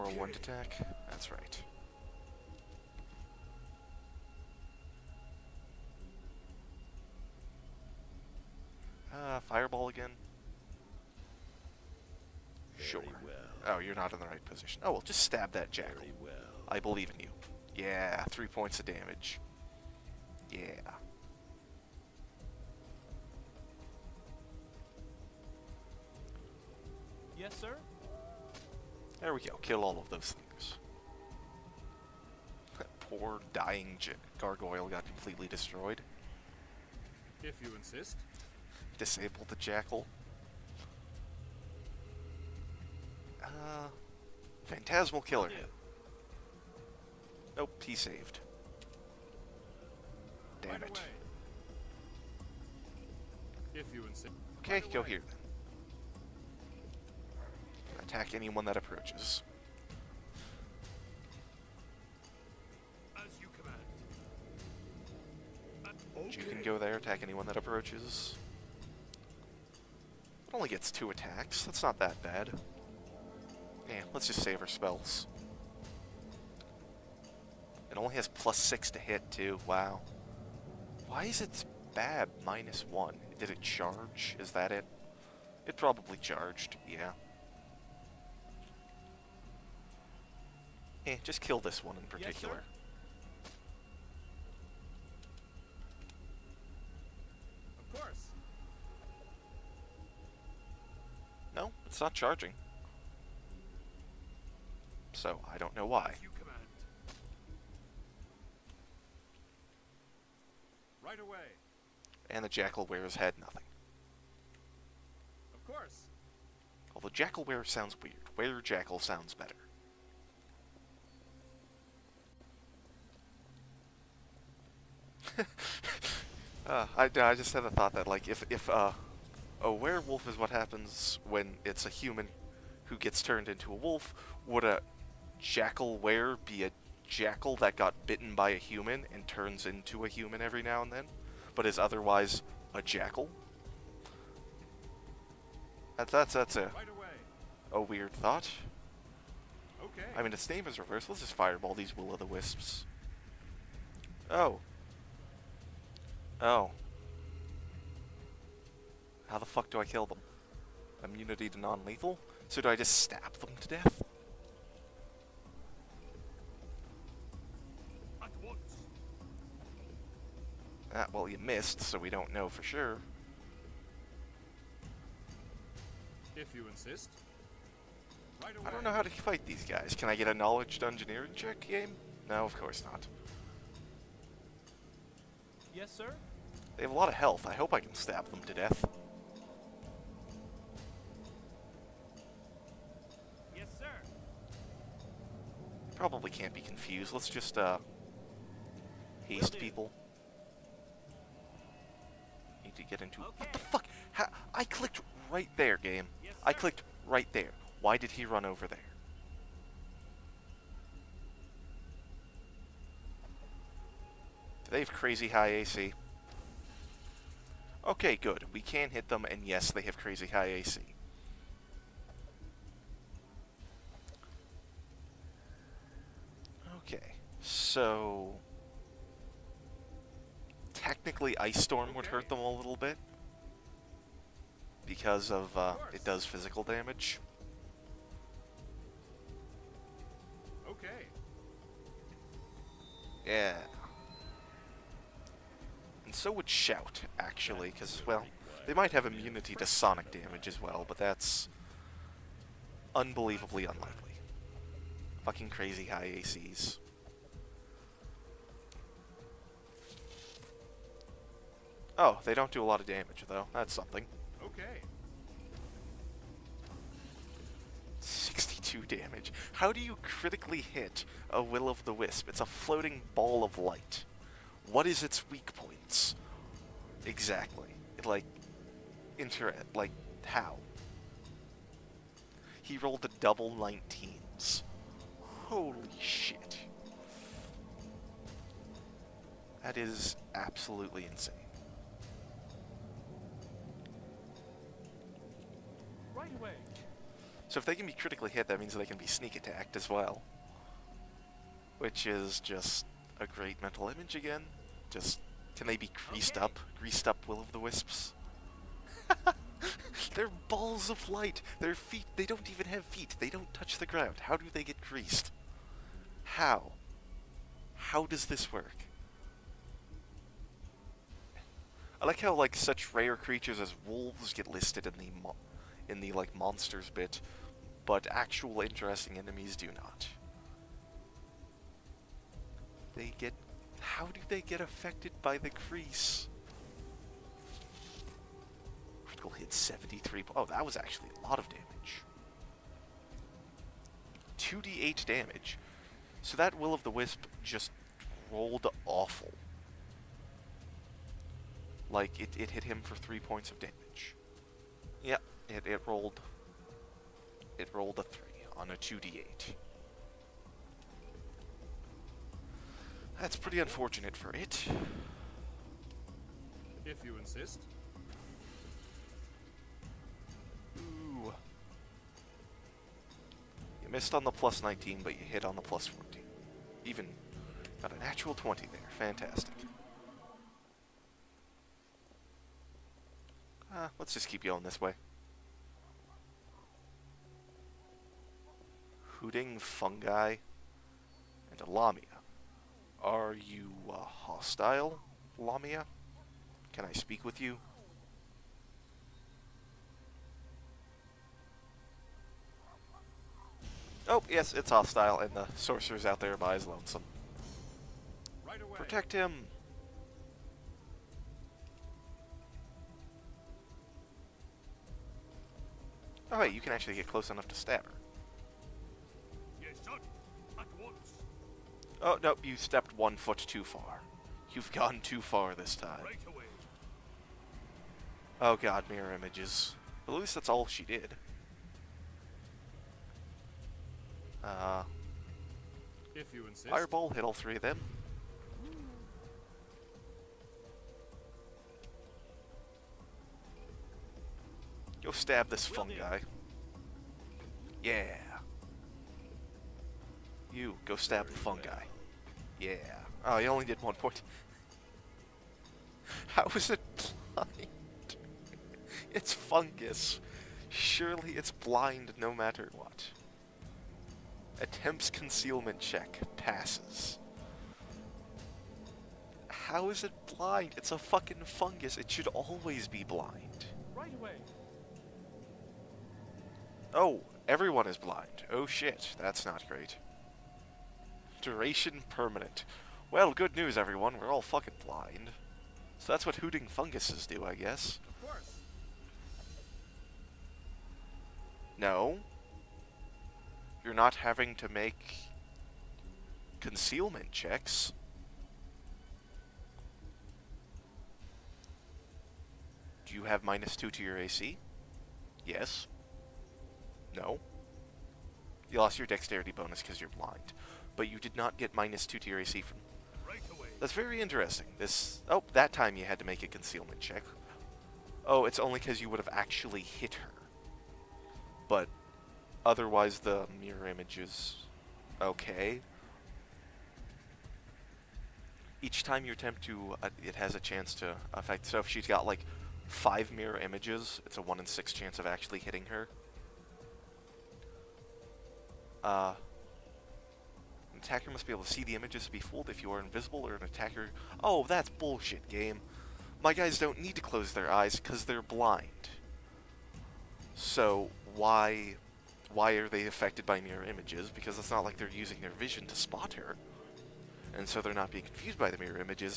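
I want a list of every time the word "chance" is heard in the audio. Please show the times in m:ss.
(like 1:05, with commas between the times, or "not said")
8:50, 8:54.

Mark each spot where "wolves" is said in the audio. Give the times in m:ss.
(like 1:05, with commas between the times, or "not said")
5:23.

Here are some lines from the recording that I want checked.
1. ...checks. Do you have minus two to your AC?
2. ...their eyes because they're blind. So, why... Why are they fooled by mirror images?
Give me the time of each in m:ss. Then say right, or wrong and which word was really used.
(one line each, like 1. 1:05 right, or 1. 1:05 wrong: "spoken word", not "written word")
1. 8:17 right
2. 9:07 wrong: "affected", not "fooled".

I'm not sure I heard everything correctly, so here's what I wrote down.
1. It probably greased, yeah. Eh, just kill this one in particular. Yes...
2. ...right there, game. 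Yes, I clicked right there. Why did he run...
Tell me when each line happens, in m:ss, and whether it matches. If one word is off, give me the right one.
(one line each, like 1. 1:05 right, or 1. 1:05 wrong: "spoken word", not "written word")
1. 1:25 wrong: "charged", not "greased"
2. 3:25 right.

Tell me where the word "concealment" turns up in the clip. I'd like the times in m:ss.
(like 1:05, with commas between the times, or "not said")
7:45, 8:16, 8:36.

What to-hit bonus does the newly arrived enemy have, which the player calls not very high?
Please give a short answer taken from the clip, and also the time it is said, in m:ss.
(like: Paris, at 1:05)
+6, at 1:18.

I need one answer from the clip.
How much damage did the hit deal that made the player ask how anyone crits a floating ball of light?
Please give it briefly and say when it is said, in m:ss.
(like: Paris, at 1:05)
62, at 4:28.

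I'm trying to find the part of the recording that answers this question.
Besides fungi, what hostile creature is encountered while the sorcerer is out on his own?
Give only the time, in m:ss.
6:31.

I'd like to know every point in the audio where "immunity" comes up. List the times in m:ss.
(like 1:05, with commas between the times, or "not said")
2:41, 4:09.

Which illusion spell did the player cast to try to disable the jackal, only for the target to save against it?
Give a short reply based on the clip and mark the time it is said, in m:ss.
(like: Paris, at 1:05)
Phantasmal Killer, at 0:44.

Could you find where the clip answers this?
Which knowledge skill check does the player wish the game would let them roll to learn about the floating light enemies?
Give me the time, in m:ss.
3:00.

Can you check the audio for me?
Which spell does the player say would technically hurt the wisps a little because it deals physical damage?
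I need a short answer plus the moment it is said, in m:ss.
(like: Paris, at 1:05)
Ice Storm, at 3:51.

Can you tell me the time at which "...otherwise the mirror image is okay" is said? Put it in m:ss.
8:42.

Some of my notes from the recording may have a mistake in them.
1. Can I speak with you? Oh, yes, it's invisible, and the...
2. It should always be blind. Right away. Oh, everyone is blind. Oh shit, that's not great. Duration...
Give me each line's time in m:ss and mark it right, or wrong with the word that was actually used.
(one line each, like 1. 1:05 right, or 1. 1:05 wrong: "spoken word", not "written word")
1. 6:36 wrong: "hostile", not "invisible"
2. 7:51 right.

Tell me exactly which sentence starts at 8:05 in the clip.
So that's what hooting funguses do, I guess.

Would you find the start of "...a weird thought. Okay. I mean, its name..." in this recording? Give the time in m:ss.
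2:27.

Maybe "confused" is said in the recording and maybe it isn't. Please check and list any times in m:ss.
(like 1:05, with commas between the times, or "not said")
3:16, 9:18.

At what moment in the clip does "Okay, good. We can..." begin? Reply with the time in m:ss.
3:37.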